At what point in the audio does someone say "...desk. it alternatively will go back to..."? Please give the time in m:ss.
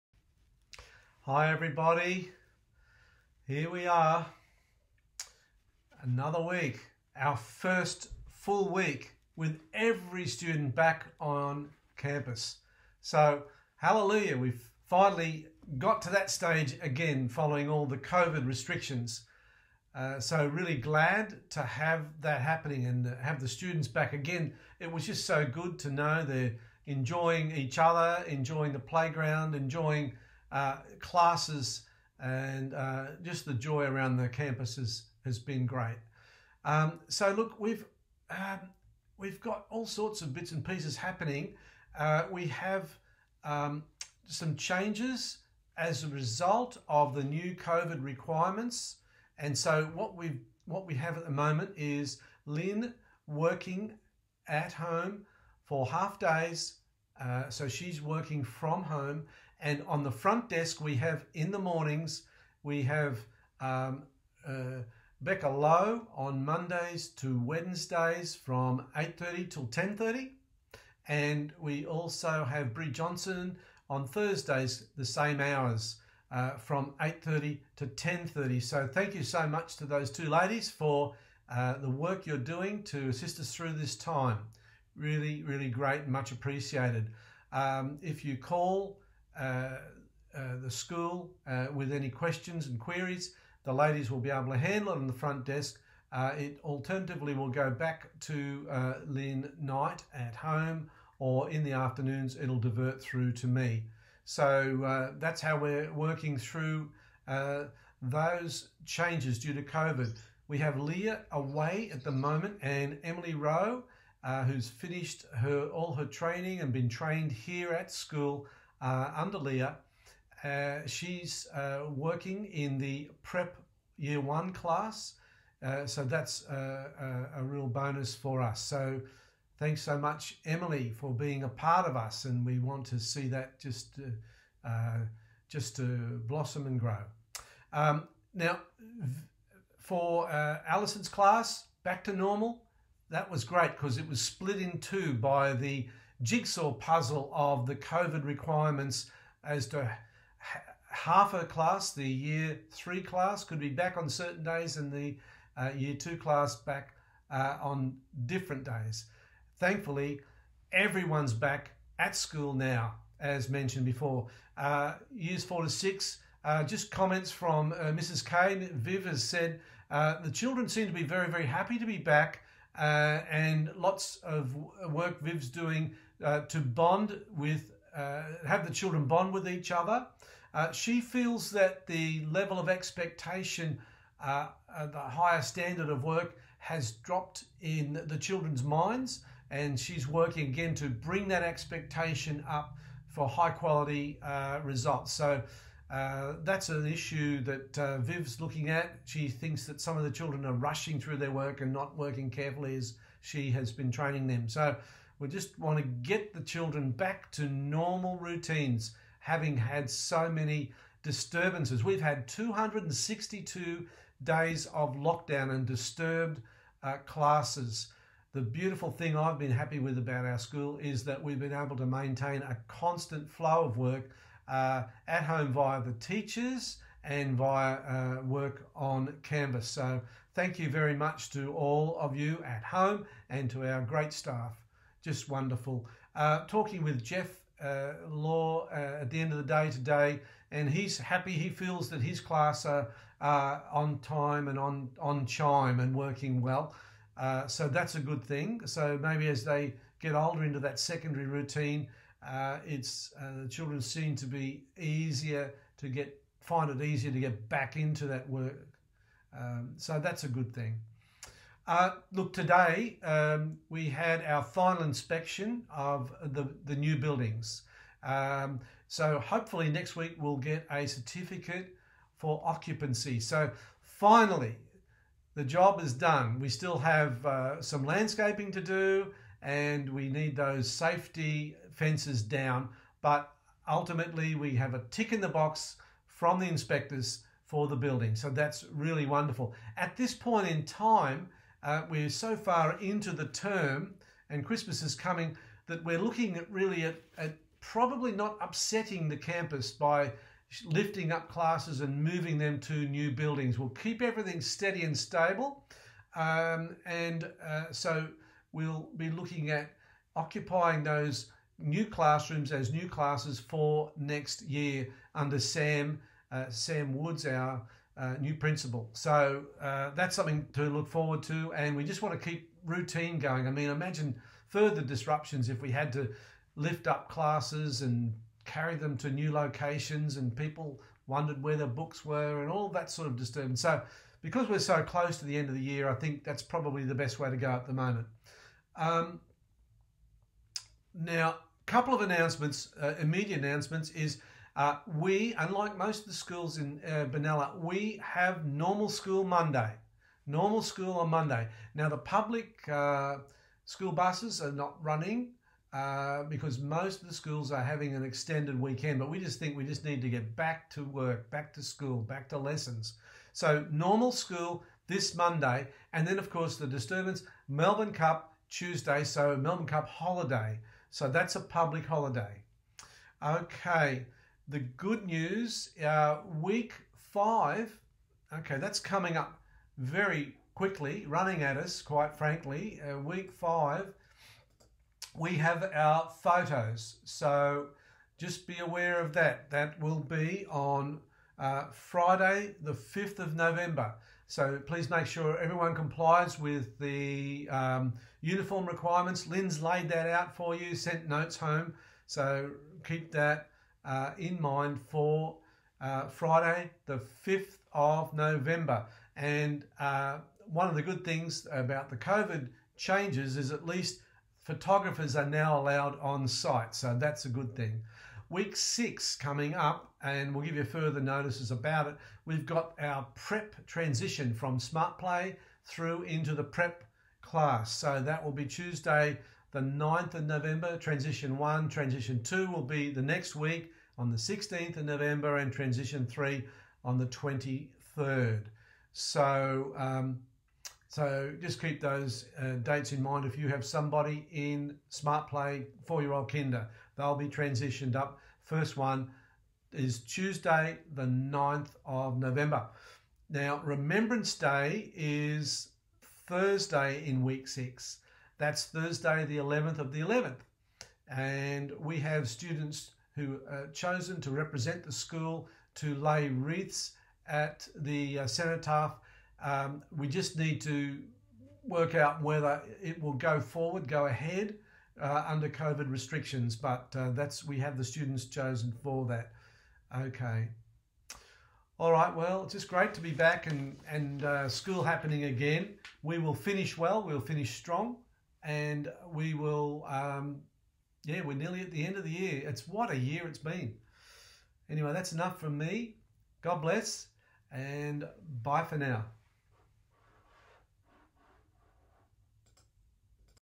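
1:35.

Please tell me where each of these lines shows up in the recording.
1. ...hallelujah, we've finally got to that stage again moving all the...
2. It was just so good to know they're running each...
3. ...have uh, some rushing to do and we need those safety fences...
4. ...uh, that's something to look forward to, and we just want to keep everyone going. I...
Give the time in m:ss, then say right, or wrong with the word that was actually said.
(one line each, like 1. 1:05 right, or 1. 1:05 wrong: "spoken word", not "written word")
1. 0:13 wrong: "following", not "moving"
2. 0:24 wrong: "enjoying", not "running"
3. 4:36 wrong: "landscaping", not "rushing"
4. 5:19 wrong: "routine", not "everyone".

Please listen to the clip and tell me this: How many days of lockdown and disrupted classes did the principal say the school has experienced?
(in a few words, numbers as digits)
262.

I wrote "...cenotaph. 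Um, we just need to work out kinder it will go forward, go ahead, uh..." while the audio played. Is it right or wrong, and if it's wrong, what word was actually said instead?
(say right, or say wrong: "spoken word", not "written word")
wrong: "whether", not "kinder".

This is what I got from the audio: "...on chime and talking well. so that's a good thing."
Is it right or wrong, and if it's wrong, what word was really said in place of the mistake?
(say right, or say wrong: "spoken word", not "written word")
wrong: "working", not "talking".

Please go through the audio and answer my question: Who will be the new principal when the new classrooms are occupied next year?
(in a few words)
Sam Woods.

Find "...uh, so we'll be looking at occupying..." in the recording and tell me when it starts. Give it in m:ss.
5:07.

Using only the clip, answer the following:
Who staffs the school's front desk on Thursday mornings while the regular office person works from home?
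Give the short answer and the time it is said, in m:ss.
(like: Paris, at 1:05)
Brie Johnson, at 1:12.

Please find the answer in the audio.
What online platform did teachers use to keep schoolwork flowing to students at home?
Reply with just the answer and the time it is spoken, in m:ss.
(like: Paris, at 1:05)
Canvas, at 3:49.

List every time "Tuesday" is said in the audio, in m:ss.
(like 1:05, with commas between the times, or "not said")
6:08, 7:08, 7:29.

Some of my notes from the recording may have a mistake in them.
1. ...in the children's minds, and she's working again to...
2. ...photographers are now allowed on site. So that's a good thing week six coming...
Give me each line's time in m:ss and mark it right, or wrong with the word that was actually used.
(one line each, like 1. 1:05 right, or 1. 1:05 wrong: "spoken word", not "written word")
1. 3:07 right
2. 6:54 right.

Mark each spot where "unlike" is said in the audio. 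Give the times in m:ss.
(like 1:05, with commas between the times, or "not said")
5:45.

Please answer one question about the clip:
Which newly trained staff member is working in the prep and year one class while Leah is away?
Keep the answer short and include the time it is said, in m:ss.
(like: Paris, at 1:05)
Emily Rowe, at 1:53.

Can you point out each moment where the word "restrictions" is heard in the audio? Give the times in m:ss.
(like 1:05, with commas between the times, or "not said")
0:18, 7:55.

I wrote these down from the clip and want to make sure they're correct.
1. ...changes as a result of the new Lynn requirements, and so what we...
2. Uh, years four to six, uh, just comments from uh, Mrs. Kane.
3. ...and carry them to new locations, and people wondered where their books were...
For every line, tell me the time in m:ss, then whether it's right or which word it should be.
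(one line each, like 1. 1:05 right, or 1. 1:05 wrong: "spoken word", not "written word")
1. 0:44 wrong: "COVID", not "Lynn"
2. 2:44 right
3. 5:27 right.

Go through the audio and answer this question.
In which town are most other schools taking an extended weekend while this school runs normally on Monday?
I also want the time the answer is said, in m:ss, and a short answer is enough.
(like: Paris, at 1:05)
Benalla, at 5:47.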